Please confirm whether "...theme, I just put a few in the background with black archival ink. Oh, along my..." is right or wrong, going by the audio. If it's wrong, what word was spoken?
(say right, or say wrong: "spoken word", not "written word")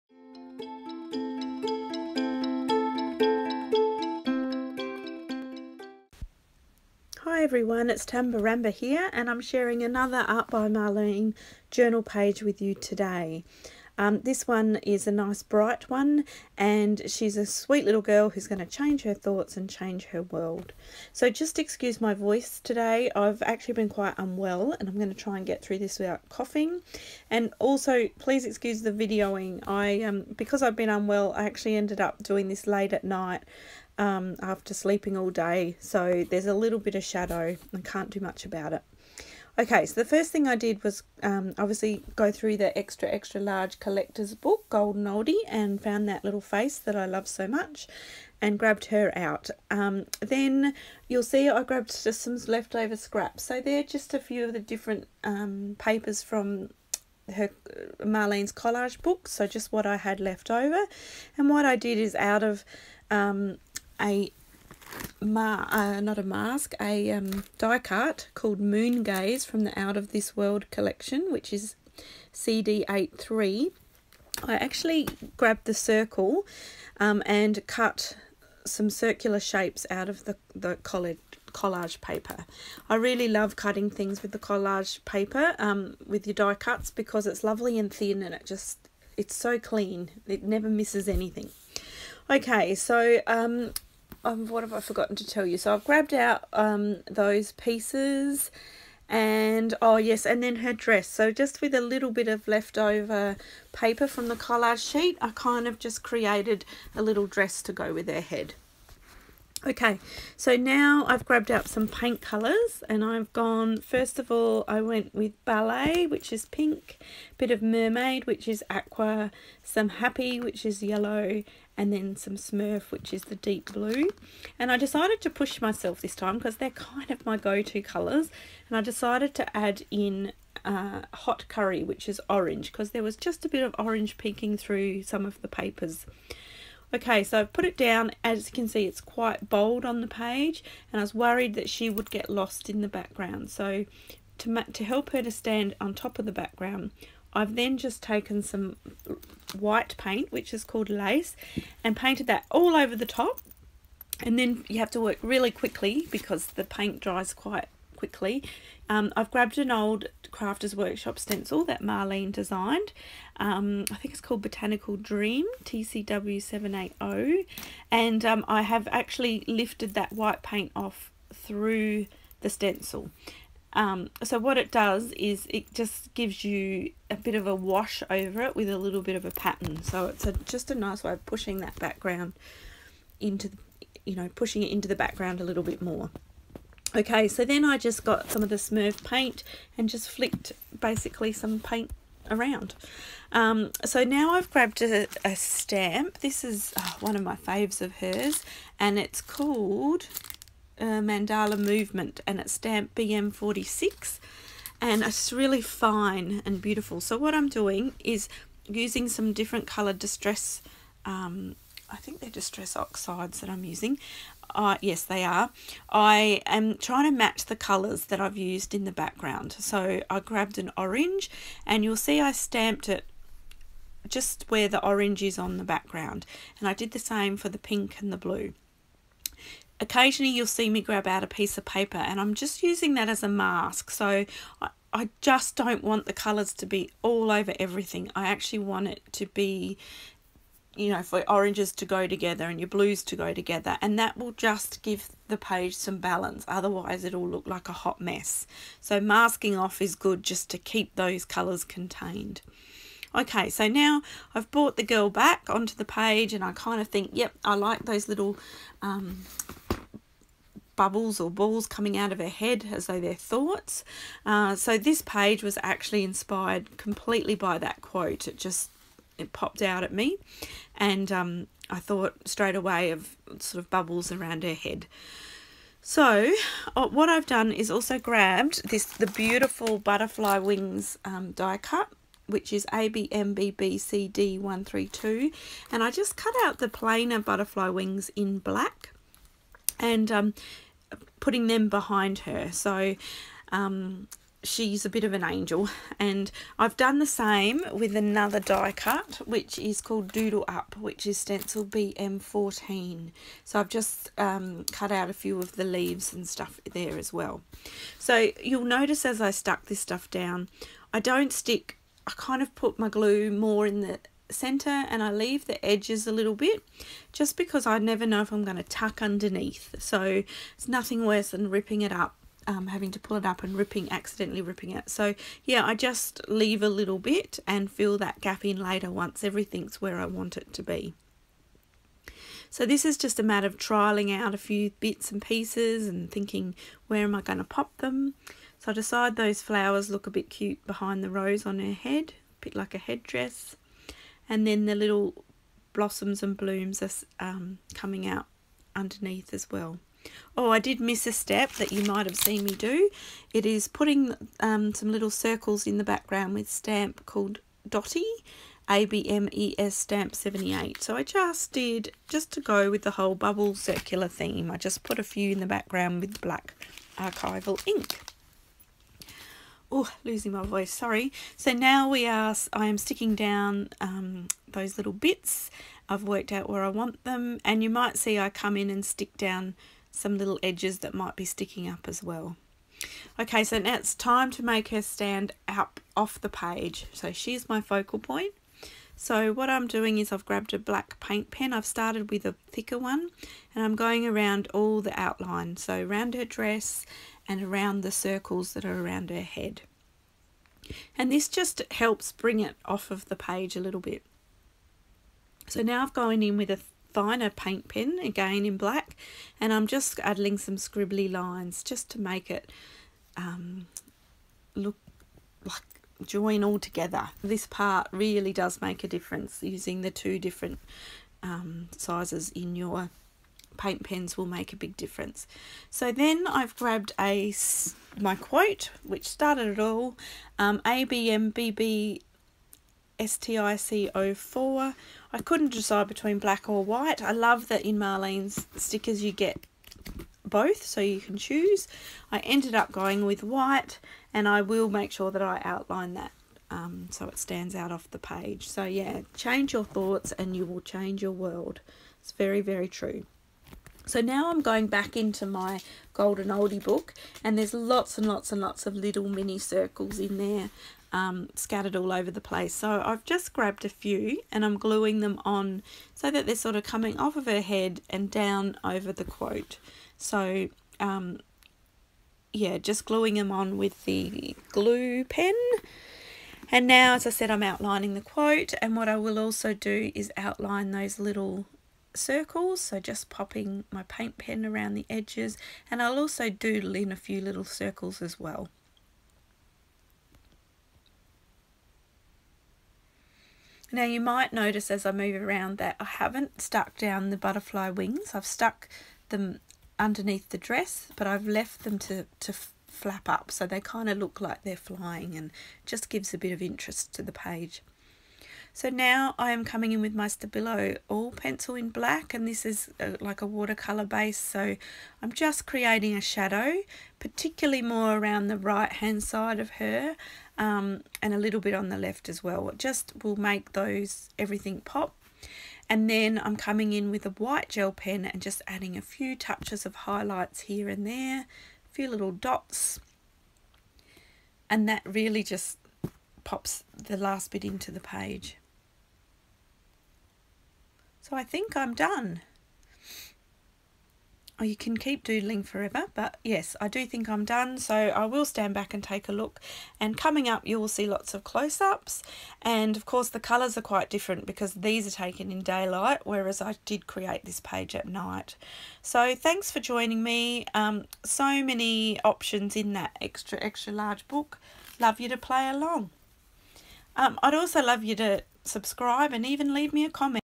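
wrong: "losing", not "along".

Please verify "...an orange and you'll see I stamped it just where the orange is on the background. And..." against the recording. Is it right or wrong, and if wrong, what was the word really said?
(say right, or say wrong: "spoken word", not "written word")
right.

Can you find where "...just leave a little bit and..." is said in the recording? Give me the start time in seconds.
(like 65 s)
325 s.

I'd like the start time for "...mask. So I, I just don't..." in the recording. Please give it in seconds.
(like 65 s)
233 s.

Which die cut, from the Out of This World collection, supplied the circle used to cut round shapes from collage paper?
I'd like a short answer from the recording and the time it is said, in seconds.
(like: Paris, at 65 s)
Moon Gazer, at 68 s.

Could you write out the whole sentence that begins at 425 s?
So then I've grabbed a my quote which started it all um, ABMBB STIC04.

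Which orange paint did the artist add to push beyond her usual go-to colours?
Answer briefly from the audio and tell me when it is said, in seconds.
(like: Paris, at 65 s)
Hot Curry, at 131 s.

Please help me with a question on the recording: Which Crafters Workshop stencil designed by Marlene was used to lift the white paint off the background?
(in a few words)
Botanical Dream.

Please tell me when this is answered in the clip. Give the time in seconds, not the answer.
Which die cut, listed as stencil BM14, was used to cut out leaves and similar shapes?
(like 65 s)
300 s.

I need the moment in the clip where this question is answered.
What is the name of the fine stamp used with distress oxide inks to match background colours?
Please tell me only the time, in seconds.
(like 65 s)
201 s.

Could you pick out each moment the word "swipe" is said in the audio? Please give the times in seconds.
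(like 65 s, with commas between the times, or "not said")
not said.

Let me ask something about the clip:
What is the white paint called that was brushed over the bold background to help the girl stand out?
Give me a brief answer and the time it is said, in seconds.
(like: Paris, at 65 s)
Lace, at 150 s.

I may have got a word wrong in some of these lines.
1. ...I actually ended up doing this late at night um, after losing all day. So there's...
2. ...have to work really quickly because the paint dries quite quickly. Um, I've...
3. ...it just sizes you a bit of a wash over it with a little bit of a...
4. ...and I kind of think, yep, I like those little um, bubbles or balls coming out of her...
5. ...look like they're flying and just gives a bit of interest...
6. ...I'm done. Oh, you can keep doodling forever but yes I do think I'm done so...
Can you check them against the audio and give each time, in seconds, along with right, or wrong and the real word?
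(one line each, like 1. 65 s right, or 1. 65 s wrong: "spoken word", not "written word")
1. 31 s wrong: "sleeping", not "losing"
2. 154 s right
3. 175 s wrong: "gives", not "sizes"
4. 256 s right
5. 503 s right
6. 541 s right.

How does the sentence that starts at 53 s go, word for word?
So they're just a few of the different um, papers from her Marlene's collage book, so just what I had left over.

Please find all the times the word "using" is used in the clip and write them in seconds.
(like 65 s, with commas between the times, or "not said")
208 s, 213 s, 232 s, 419 s.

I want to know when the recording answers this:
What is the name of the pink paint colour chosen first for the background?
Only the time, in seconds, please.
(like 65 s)
115 s.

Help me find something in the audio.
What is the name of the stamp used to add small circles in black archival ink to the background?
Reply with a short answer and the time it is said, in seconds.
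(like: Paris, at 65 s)
Dotty, at 357 s.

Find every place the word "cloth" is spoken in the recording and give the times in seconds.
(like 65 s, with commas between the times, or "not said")
not said.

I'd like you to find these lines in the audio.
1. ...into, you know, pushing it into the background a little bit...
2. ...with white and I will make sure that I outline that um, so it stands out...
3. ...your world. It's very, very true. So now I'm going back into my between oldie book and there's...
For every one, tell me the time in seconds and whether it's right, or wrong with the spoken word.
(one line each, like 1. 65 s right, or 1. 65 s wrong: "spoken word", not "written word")
1. 183 s right
2. 443 s right
3. 451 s wrong: "golden", not "between".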